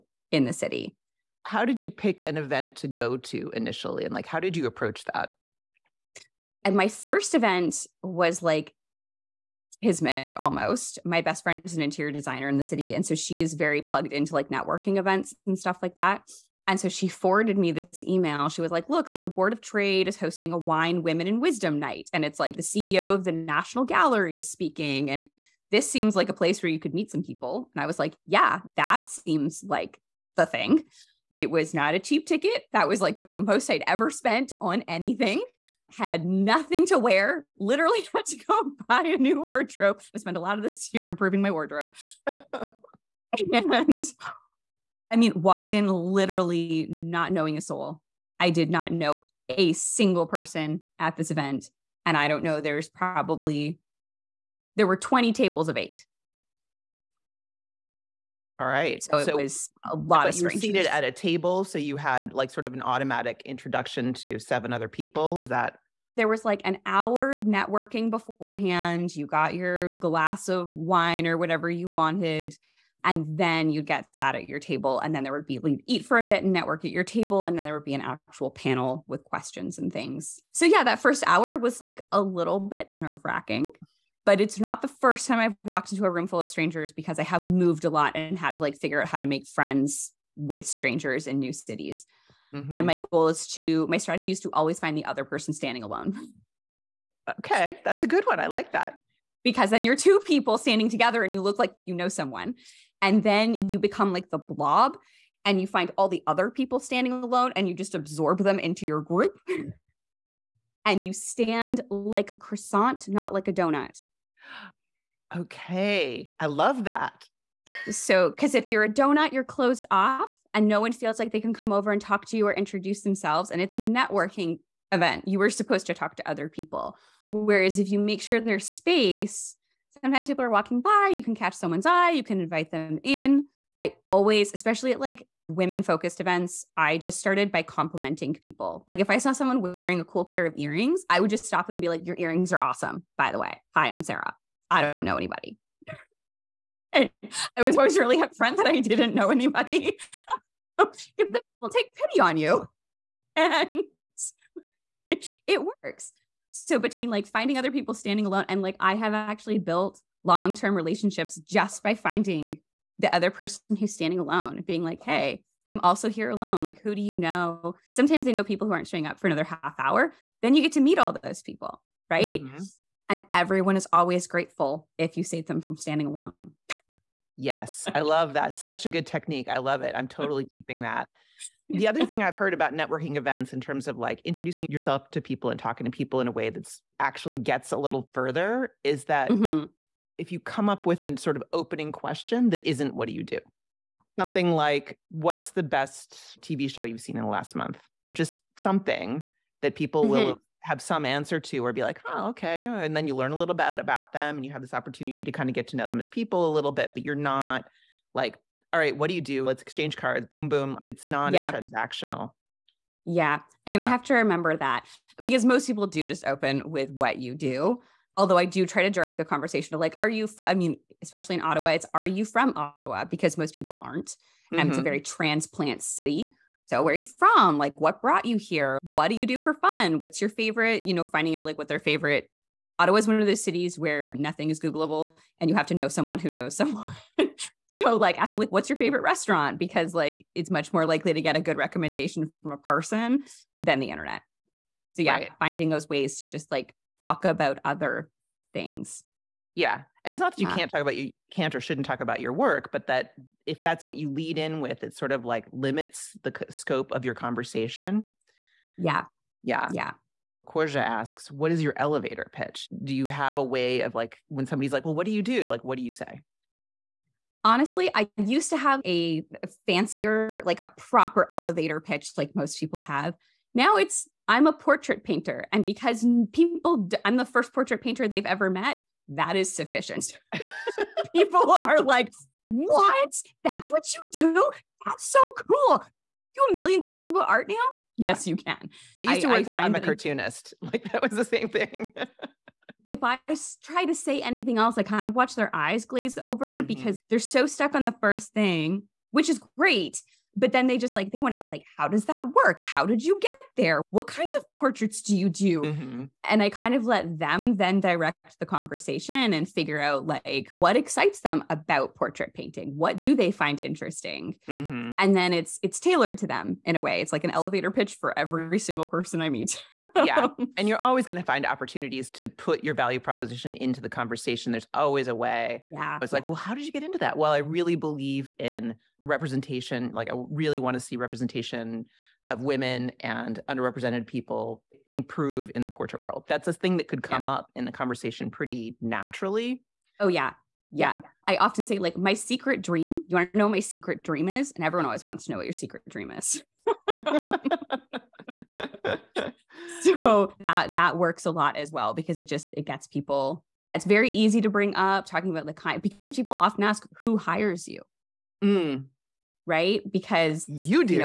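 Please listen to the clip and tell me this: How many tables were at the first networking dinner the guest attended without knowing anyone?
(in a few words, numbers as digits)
20.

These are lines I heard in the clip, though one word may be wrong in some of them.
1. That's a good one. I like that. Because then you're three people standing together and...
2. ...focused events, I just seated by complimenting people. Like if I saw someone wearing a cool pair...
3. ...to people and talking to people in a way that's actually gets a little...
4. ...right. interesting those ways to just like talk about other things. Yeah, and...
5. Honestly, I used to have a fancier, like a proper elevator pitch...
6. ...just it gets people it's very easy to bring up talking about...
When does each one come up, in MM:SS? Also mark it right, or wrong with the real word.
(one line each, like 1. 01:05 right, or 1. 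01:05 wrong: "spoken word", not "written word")
1. 01:37 wrong: "two", not "three"
2. 02:15 wrong: "started", not "seated"
3. 03:05 right
4. 04:05 wrong: "finding", not "interesting"
5. 04:27 right
6. 05:52 right.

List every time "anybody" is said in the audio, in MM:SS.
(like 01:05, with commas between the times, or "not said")
02:25, 02:29.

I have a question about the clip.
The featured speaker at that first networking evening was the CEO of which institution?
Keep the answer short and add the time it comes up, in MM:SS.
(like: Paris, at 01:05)
National Gallery, at 00:23.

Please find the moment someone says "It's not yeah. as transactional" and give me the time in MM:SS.
03:30.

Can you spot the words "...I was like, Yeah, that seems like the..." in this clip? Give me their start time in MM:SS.
00:27.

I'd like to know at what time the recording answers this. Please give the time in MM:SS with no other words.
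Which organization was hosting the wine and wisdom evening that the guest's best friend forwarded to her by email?
00:19.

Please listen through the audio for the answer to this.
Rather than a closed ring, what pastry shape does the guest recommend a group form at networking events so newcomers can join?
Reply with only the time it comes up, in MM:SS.
01:52.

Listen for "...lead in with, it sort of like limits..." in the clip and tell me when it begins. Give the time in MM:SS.
04:14.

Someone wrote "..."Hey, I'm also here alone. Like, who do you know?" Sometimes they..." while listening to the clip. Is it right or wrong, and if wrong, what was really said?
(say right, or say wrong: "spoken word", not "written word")
right.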